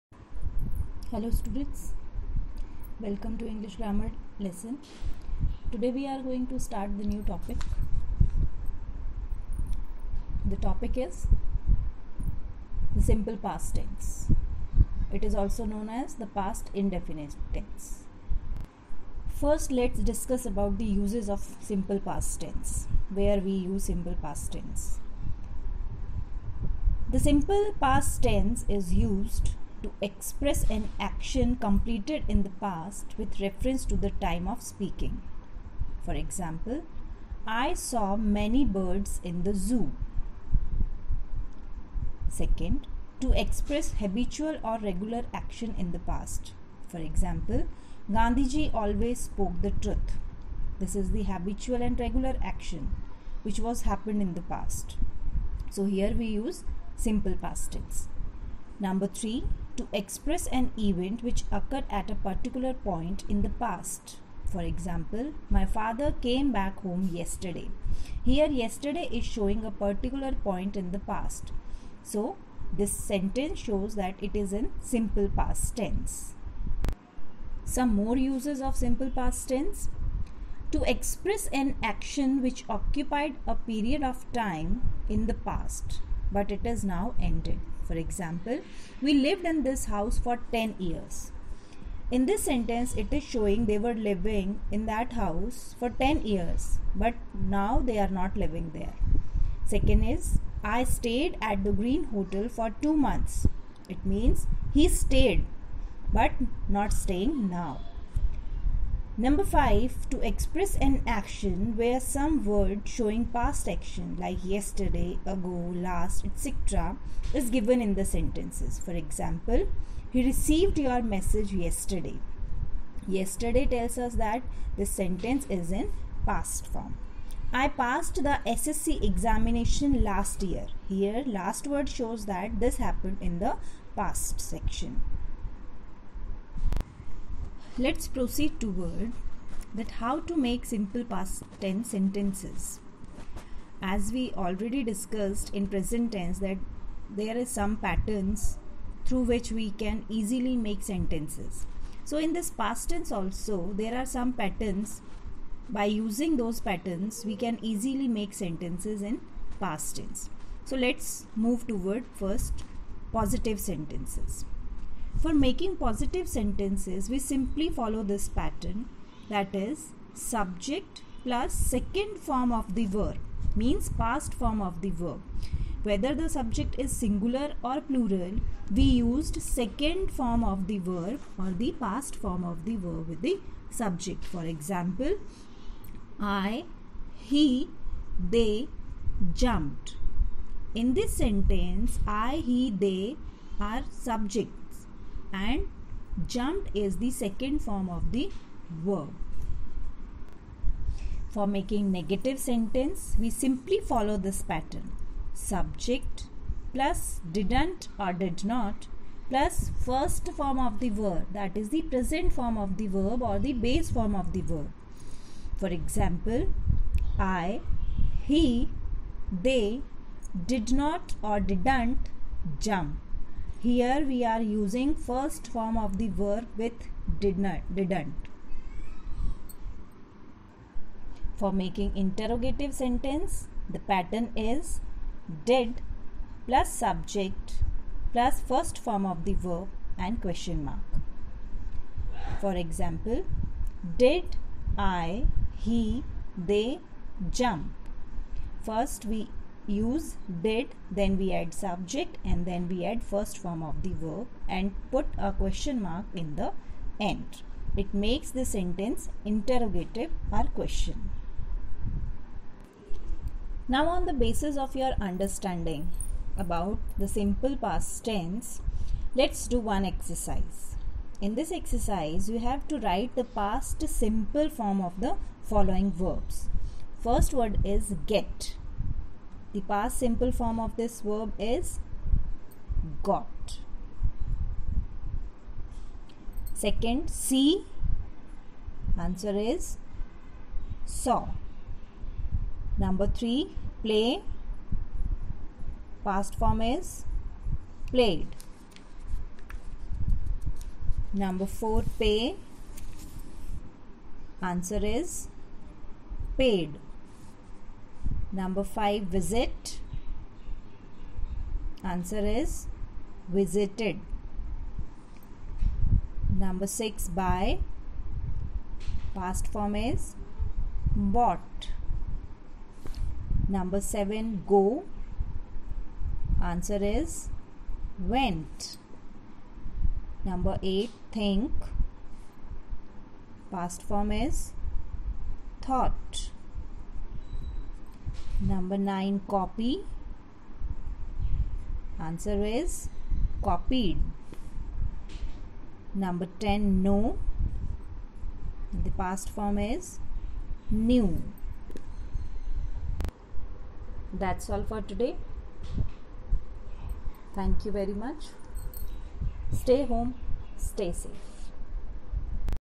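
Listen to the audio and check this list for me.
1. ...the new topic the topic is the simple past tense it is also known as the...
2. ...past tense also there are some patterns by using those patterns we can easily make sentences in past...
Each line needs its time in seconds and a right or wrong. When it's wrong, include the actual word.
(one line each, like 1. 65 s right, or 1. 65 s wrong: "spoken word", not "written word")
1. 6 s right
2. 152 s right.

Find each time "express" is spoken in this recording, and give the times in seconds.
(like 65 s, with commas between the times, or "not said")
30 s, 43 s, 59 s, 80 s, 110 s.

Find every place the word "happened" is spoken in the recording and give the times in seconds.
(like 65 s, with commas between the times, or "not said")
53 s, 132 s.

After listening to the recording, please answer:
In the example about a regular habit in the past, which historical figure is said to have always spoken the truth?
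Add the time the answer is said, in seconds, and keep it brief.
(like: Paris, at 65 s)
Gandhiji, at 48 s.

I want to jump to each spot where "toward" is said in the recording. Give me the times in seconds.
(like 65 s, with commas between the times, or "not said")
138 s, 161 s.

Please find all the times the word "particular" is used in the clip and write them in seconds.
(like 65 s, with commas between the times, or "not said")
62 s, 69 s.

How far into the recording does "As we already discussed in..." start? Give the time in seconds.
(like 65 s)
143 s.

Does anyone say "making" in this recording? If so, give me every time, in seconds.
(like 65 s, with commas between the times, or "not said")
165 s, 201 s, 231 s.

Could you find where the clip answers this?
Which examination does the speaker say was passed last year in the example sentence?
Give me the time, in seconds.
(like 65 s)
128 s.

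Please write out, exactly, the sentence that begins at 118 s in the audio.
For example, he received your message yesterday.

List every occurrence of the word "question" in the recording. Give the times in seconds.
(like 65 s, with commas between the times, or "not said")
240 s, 255 s, 260 s.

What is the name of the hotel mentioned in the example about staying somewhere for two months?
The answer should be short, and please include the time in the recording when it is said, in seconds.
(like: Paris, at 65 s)
Green Hotel, at 101 s.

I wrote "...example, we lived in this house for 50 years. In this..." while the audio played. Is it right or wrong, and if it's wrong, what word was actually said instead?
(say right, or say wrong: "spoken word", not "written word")
wrong: "10", not "50".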